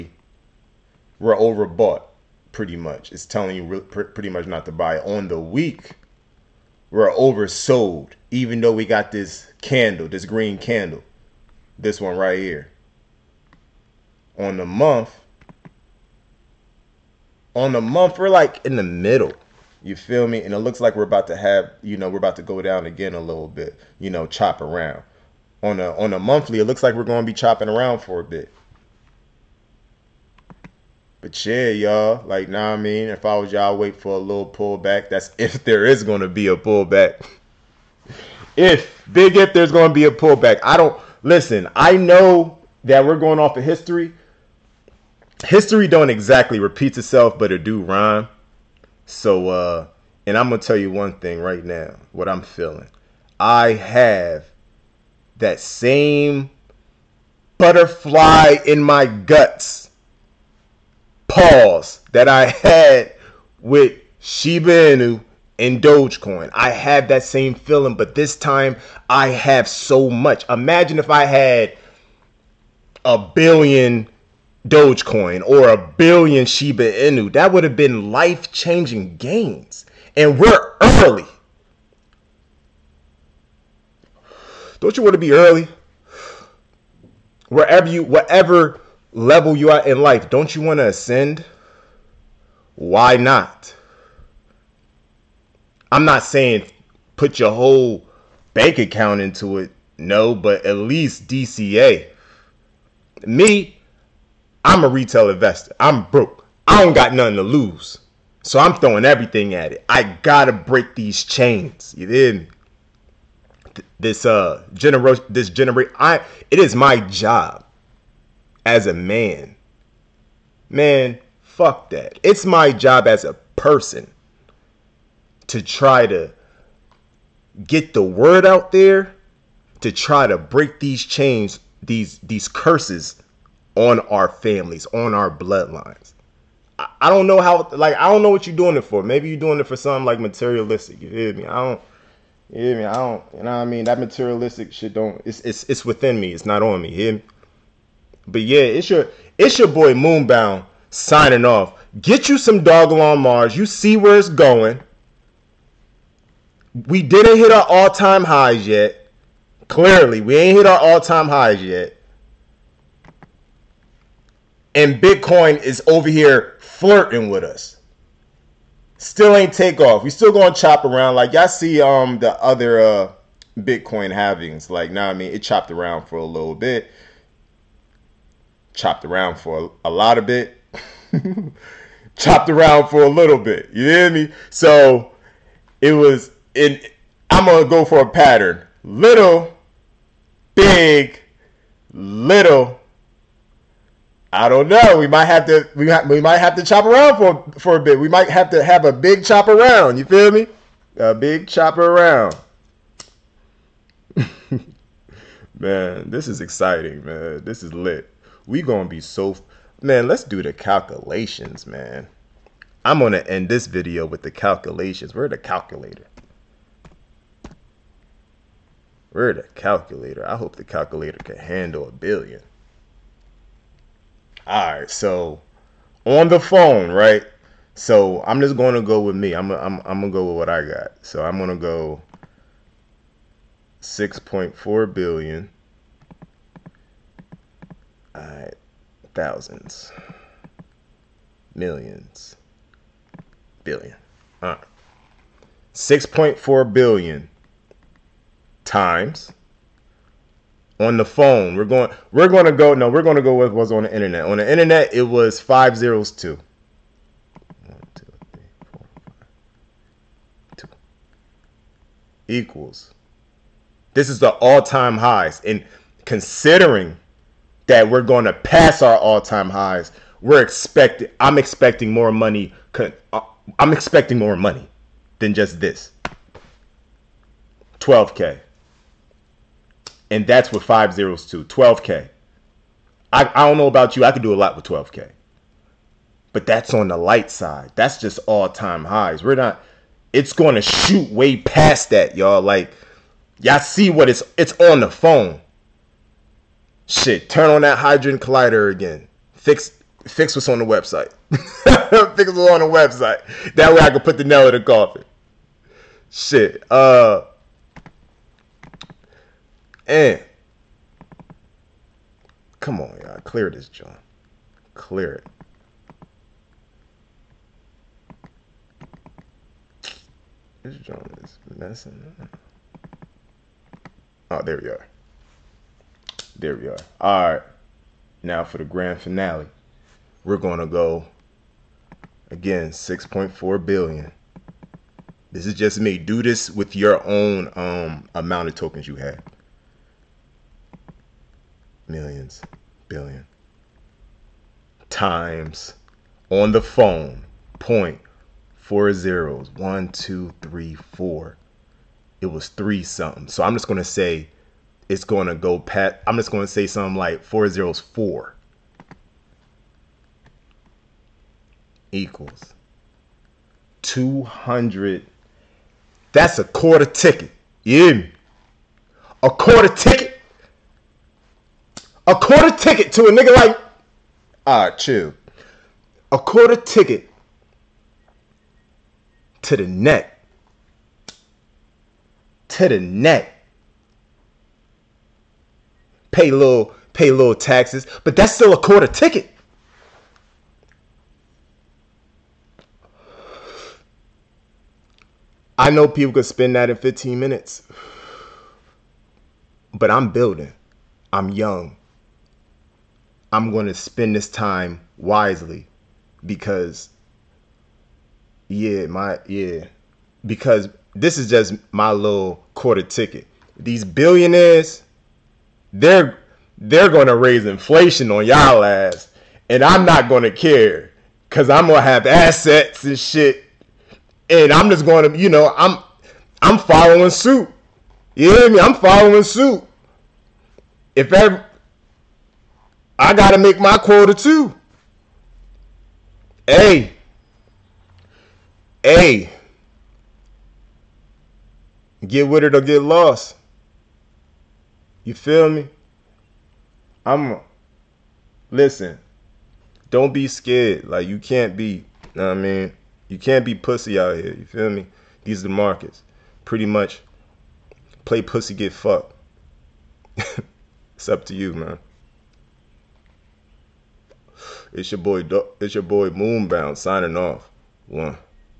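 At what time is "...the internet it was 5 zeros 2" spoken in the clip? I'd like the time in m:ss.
4:14.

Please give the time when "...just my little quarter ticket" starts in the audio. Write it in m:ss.
6:51.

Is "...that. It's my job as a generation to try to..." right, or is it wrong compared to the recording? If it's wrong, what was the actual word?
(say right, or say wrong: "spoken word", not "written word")
wrong: "person", not "generation".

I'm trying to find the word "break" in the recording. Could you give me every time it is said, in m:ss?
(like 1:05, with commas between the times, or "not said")
1:50, 2:10.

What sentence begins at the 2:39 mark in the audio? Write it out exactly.
Clearly, we ain't hit our all time highs yet.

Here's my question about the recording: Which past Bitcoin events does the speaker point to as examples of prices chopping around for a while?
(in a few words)
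Bitcoin halvings.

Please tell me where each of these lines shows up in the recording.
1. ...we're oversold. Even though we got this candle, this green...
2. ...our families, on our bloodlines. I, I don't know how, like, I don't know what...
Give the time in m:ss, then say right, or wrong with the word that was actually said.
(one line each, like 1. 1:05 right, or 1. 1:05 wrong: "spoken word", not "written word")
1. 0:06 right
2. 2:14 right.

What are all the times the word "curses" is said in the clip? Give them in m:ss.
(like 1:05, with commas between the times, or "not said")
2:12.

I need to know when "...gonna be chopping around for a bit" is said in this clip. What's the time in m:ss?
0:27.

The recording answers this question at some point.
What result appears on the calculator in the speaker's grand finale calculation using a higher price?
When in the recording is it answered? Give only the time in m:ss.
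6:03.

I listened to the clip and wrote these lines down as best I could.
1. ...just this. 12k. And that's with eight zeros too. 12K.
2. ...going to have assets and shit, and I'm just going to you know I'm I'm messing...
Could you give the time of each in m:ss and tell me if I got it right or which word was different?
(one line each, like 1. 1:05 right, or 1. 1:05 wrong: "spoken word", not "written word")
1. 4:35 wrong: "five", not "eight"
2. 7:01 wrong: "following", not "messing".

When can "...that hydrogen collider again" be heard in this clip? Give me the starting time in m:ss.
4:57.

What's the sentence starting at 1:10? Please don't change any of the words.
Imagine if I had a billion Dogecoin or a billion Shiba Inu.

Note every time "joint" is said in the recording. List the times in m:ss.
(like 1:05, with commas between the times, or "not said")
5:13, 5:20.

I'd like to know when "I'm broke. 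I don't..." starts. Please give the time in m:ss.
1:45.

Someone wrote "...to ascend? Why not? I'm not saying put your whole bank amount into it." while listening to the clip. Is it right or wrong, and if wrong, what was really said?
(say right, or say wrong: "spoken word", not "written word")
wrong: "account", not "amount".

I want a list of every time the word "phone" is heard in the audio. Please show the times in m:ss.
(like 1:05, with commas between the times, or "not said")
3:46, 4:11, 4:54, 5:46.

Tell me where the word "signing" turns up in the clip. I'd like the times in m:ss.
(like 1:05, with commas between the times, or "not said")
2:30, 7:46.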